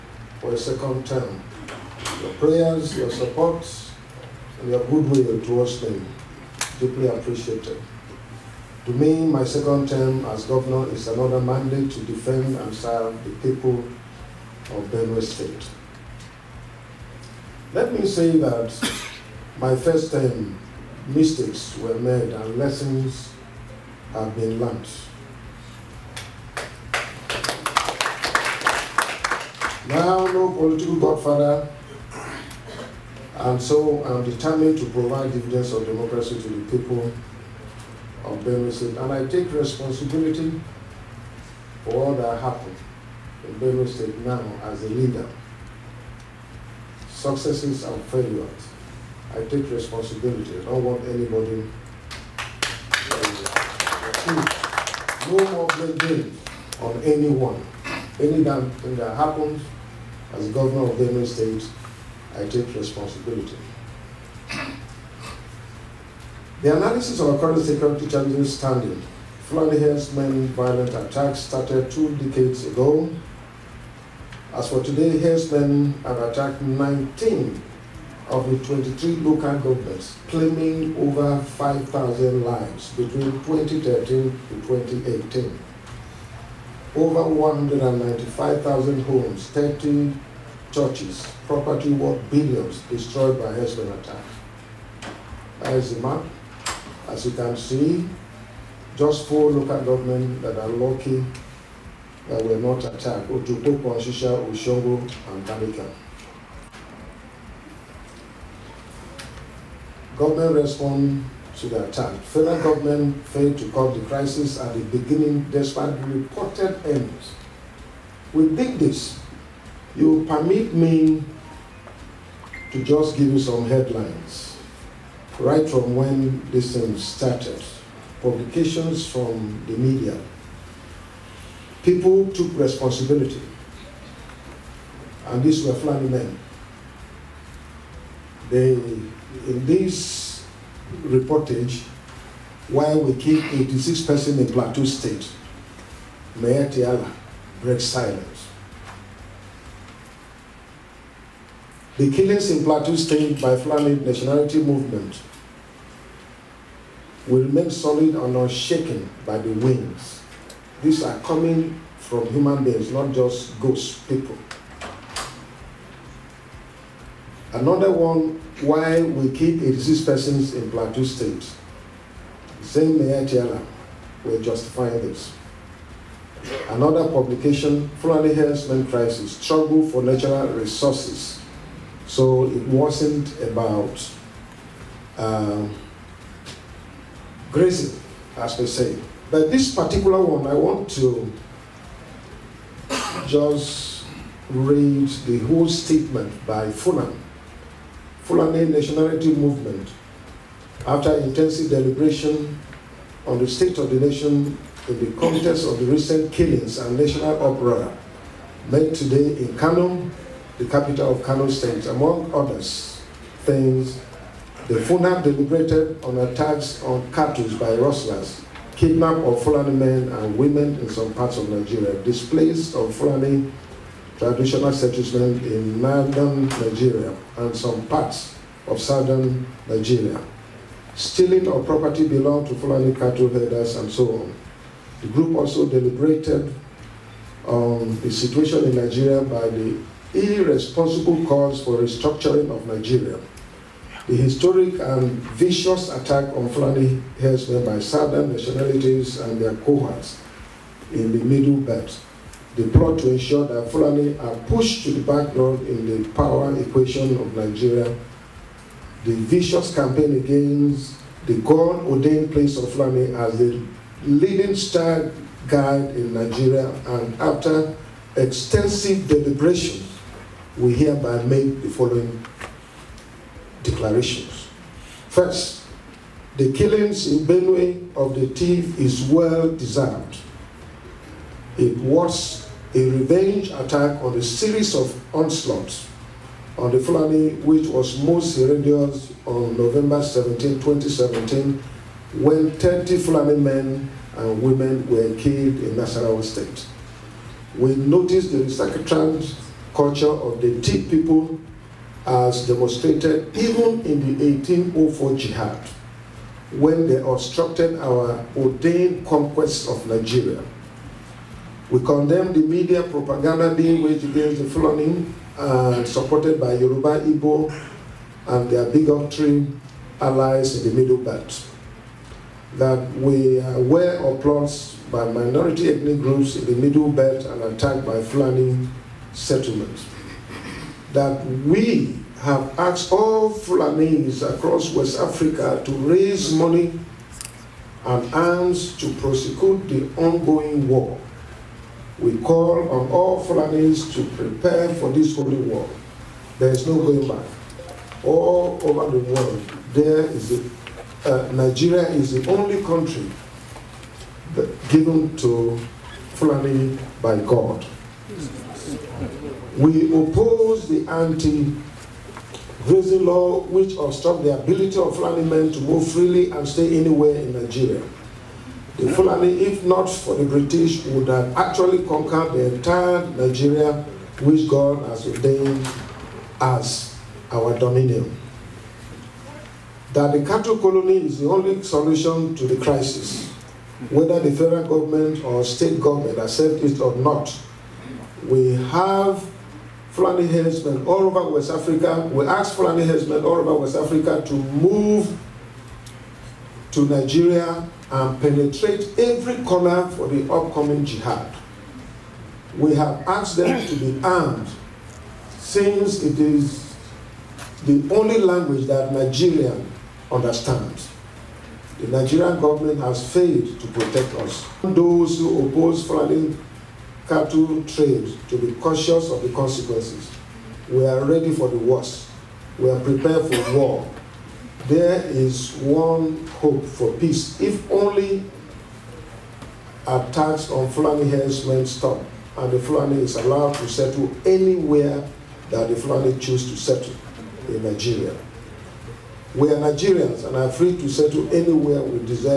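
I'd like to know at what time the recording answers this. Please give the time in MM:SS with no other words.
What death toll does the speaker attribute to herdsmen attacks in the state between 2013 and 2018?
01:20.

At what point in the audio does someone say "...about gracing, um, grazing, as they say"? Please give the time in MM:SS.
03:03.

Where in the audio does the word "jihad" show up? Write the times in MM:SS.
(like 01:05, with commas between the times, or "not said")
05:05, 06:40.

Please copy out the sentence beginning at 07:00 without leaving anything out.
We are ready for the worst.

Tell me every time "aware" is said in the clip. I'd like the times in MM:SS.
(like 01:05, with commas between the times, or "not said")
05:23.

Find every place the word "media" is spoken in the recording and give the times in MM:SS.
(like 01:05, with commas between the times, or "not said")
02:09, 05:12.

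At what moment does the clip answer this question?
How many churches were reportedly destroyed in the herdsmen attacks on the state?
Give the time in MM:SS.
01:29.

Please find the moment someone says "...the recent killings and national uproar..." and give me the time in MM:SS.
03:25.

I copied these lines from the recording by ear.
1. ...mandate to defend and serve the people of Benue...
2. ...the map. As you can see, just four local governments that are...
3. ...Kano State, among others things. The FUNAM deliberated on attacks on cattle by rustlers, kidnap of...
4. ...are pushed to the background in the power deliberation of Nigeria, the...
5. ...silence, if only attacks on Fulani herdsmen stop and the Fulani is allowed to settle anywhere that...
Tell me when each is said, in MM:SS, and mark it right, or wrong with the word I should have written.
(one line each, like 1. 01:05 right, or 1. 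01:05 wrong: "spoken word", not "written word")
1. 00:11 right
2. 01:35 right
3. 03:31 right
4. 04:14 wrong: "equation", not "deliberation"
5. 07:06 wrong: "peace", not "silence".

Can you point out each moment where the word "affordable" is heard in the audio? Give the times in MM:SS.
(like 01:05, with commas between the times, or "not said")
not said.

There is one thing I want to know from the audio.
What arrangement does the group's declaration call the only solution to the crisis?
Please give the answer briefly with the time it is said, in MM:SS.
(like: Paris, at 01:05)
cattle colony, at 06:20.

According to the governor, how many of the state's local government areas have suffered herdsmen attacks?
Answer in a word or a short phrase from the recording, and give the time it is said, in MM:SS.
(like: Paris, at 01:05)
19, at 01:16.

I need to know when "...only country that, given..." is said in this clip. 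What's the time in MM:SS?
05:52.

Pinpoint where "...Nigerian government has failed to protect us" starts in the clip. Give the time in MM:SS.
06:51.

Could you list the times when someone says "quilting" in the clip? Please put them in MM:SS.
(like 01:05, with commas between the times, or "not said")
not said.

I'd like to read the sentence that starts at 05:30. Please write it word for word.
That we have asked all Fulanis across West Africa to raise money and arms to prosecute the ongoing war.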